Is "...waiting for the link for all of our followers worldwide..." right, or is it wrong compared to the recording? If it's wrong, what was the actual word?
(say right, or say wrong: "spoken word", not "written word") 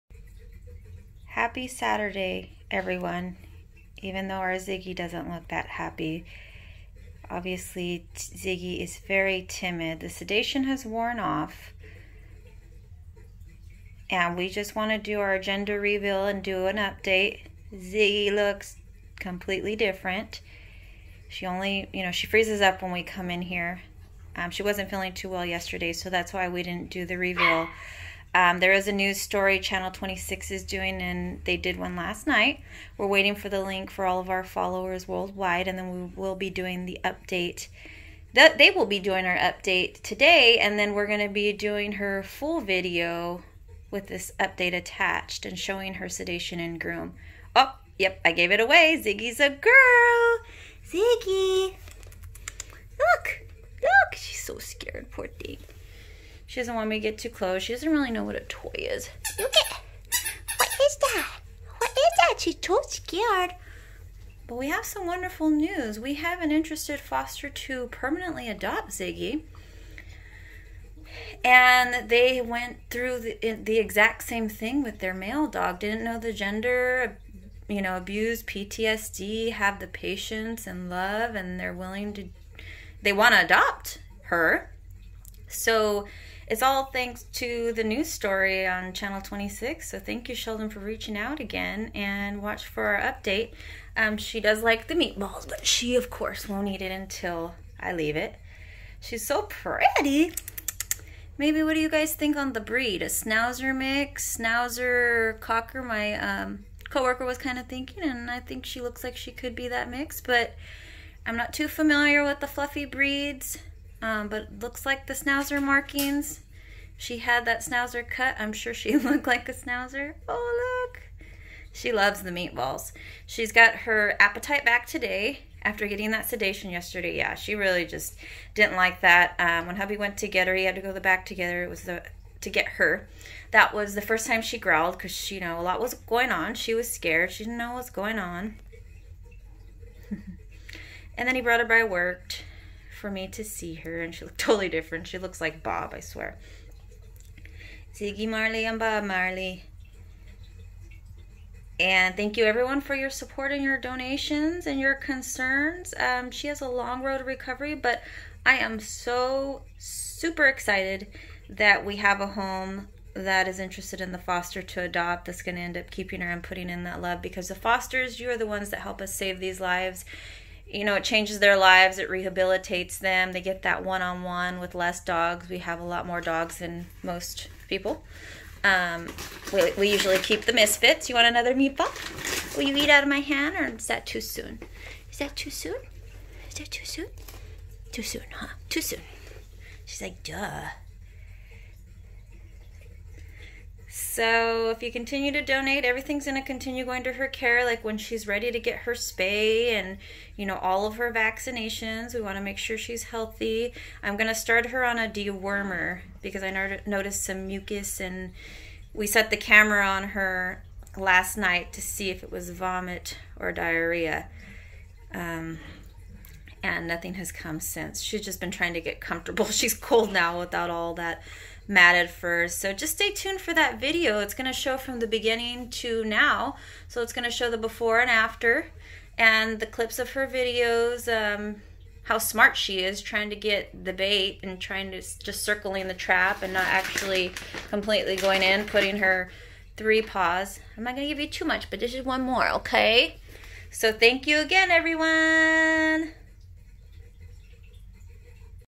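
right.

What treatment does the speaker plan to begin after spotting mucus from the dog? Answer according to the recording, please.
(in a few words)
Dewormer.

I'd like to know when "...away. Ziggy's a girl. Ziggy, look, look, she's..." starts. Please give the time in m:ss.
0:48.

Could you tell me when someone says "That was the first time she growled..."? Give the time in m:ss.
2:13.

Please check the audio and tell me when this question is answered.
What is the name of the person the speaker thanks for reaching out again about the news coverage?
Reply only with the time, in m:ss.
1:30.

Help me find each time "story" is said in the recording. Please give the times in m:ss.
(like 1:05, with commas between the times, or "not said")
0:29, 1:28.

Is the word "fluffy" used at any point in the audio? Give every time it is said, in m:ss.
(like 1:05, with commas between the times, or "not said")
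1:52.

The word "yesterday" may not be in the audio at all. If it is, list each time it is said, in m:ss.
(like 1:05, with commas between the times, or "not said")
0:25, 2:06.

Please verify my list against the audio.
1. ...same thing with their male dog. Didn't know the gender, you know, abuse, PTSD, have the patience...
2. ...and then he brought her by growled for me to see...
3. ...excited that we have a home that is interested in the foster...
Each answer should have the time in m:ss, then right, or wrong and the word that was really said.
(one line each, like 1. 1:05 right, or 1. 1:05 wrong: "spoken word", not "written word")
1. 1:14 right
2. 2:21 wrong: "worked", not "growled"
3. 2:40 right.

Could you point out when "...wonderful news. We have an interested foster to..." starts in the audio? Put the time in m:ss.
1:05.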